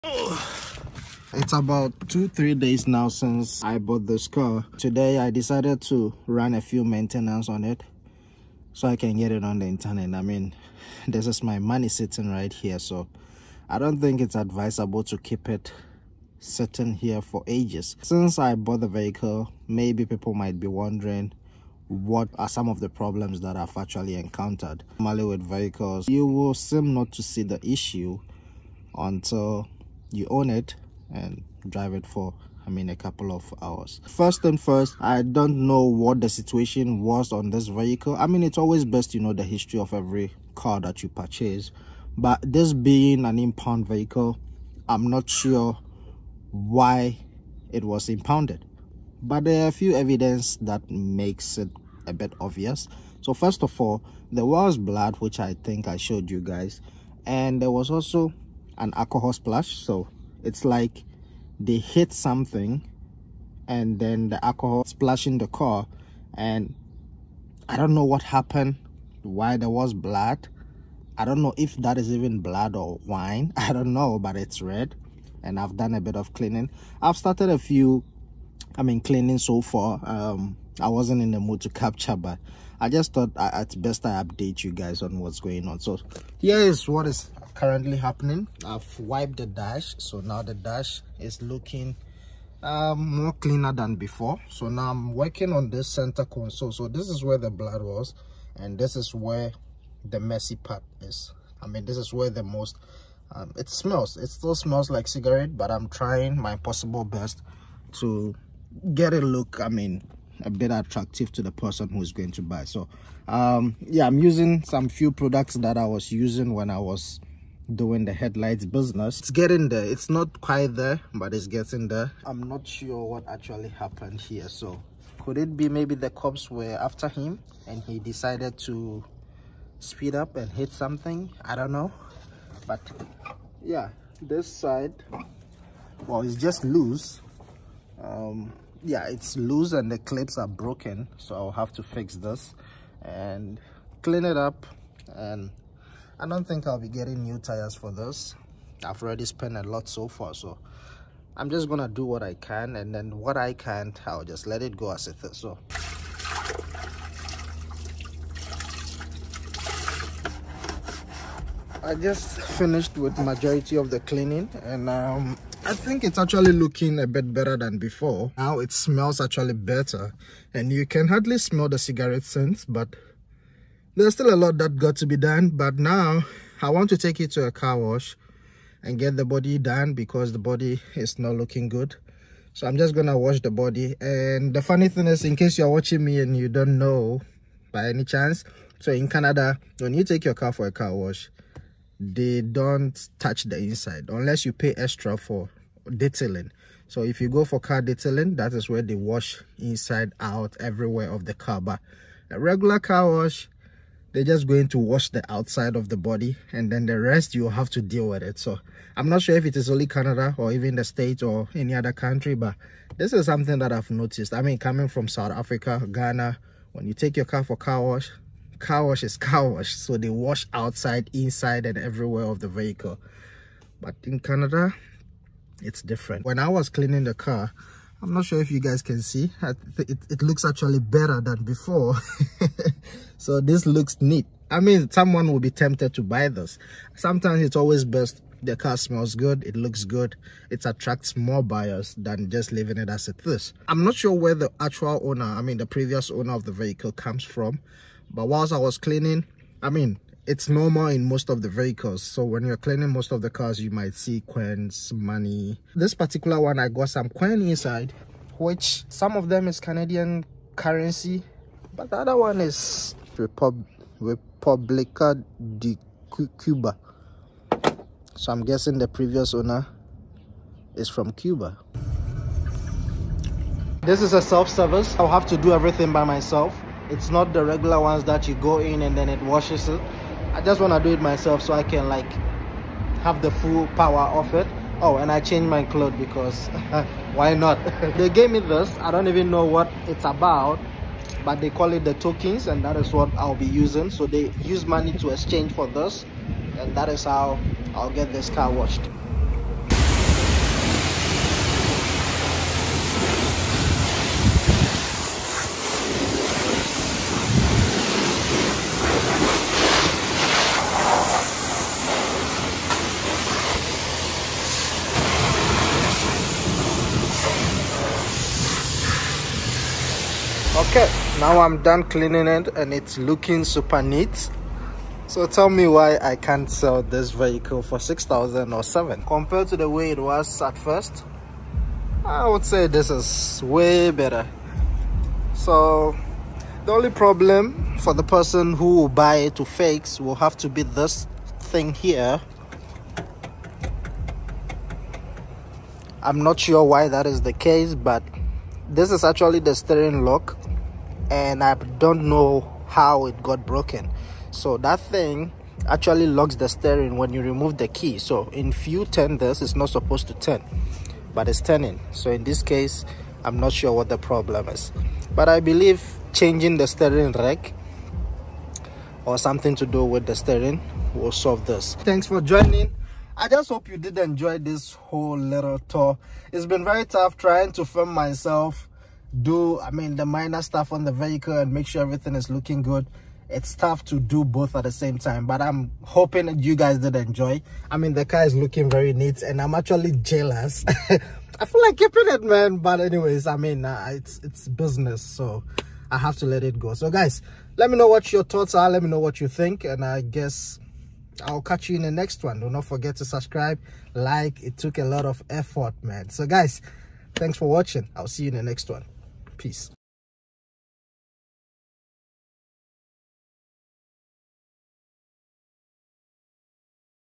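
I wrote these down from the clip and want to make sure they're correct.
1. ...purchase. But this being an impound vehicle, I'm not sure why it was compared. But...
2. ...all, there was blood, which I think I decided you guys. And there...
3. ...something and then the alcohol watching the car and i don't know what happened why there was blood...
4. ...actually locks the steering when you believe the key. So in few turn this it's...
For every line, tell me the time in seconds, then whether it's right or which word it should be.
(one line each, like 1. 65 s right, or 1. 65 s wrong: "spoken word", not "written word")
1. 41 s wrong: "impounded", not "compared"
2. 53 s wrong: "showed", not "decided"
3. 62 s wrong: "splashing", not "watching"
4. 355 s wrong: "remove", not "believe".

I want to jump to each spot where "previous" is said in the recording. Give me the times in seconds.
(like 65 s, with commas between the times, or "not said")
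245 s, 268 s.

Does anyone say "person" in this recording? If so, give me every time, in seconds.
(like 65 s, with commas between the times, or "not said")
111 s, 338 s.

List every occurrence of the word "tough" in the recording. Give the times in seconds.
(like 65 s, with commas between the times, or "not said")
376 s, 383 s.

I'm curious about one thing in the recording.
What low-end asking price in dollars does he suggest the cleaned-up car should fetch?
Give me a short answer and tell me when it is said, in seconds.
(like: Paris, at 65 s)
6000, at 327 s.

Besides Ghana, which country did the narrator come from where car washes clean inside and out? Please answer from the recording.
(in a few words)
South Africa.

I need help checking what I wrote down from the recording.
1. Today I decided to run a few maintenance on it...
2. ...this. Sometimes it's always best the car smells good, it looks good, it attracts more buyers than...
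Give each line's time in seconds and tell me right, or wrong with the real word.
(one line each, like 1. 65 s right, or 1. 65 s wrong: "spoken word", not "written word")
1. 4 s right
2. 236 s right.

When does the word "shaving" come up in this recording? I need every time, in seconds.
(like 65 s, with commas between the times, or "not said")
not said.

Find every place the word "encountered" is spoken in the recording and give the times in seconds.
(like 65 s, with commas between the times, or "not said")
24 s.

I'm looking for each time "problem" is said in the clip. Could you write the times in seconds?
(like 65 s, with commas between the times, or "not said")
22 s, 336 s, 363 s.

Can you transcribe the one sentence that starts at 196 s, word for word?
So if you go for car detailing, that is where they wash inside out everywhere of the car.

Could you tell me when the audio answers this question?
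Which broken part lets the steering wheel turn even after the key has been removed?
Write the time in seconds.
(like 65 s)
349 s.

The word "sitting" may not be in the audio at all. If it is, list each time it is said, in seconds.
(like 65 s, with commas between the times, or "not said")
11 s, 16 s.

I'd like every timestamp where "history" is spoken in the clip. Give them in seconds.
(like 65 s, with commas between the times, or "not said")
39 s.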